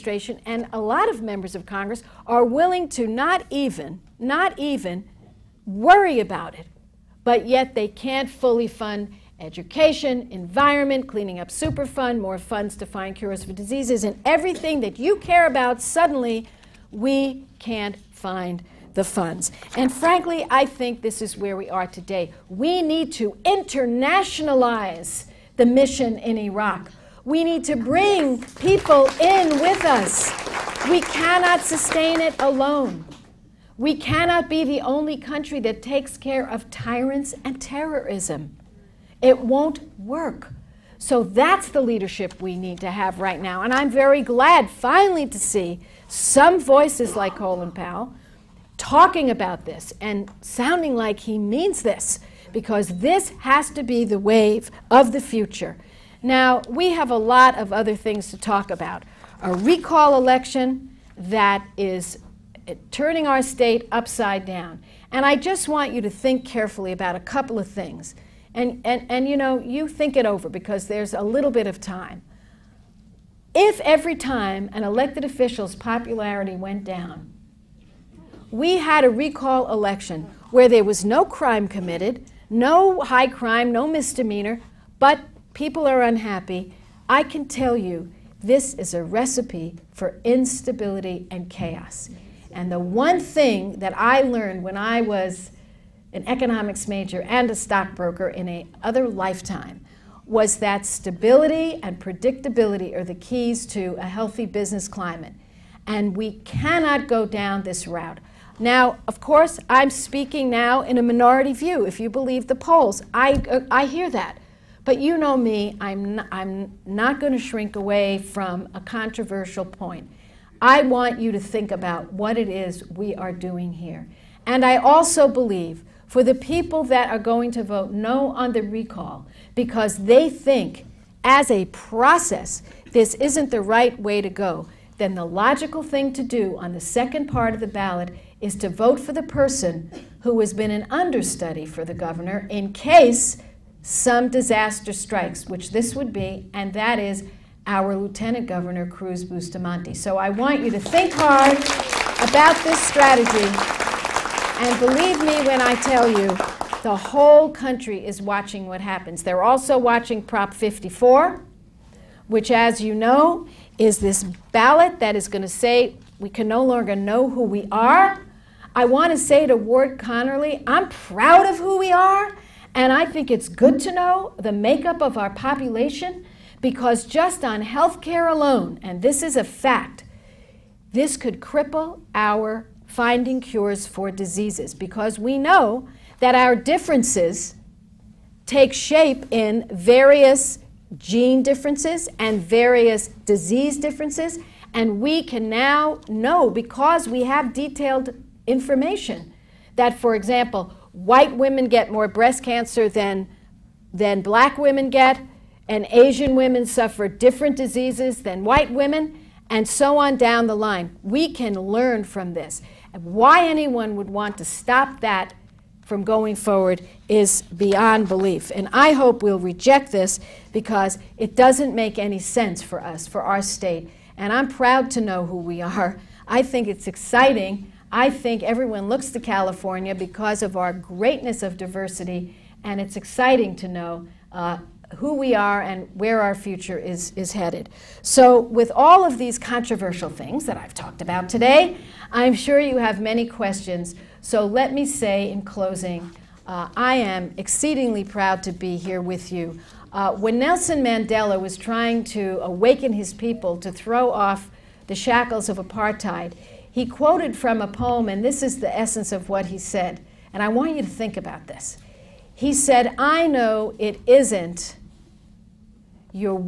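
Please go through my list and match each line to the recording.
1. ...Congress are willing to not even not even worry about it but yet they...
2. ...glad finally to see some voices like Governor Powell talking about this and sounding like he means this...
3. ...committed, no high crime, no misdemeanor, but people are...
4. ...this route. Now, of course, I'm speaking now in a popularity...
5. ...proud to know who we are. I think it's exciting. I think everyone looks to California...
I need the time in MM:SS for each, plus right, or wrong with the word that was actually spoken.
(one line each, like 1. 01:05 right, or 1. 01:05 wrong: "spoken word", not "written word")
1. 00:01 right
2. 00:44 wrong: "Colin", not "Governor"
3. 01:21 right
4. 01:47 wrong: "minority", not "popularity"
5. 03:44 right.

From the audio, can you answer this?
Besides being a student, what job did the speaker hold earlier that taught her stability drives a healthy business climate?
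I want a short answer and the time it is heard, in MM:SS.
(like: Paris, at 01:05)
stockbroker, at 01:37.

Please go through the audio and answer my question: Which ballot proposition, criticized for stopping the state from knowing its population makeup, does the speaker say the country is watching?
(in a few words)
Prop 54.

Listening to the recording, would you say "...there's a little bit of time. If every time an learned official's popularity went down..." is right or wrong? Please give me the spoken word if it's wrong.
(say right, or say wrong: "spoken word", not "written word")
wrong: "elected", not "learned".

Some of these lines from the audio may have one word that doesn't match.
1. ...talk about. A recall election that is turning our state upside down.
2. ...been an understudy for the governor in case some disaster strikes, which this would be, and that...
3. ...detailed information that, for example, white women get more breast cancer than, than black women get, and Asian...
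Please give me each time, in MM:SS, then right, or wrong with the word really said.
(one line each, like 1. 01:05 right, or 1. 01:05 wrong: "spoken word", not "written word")
1. 00:58 right
2. 02:20 right
3. 03:17 right.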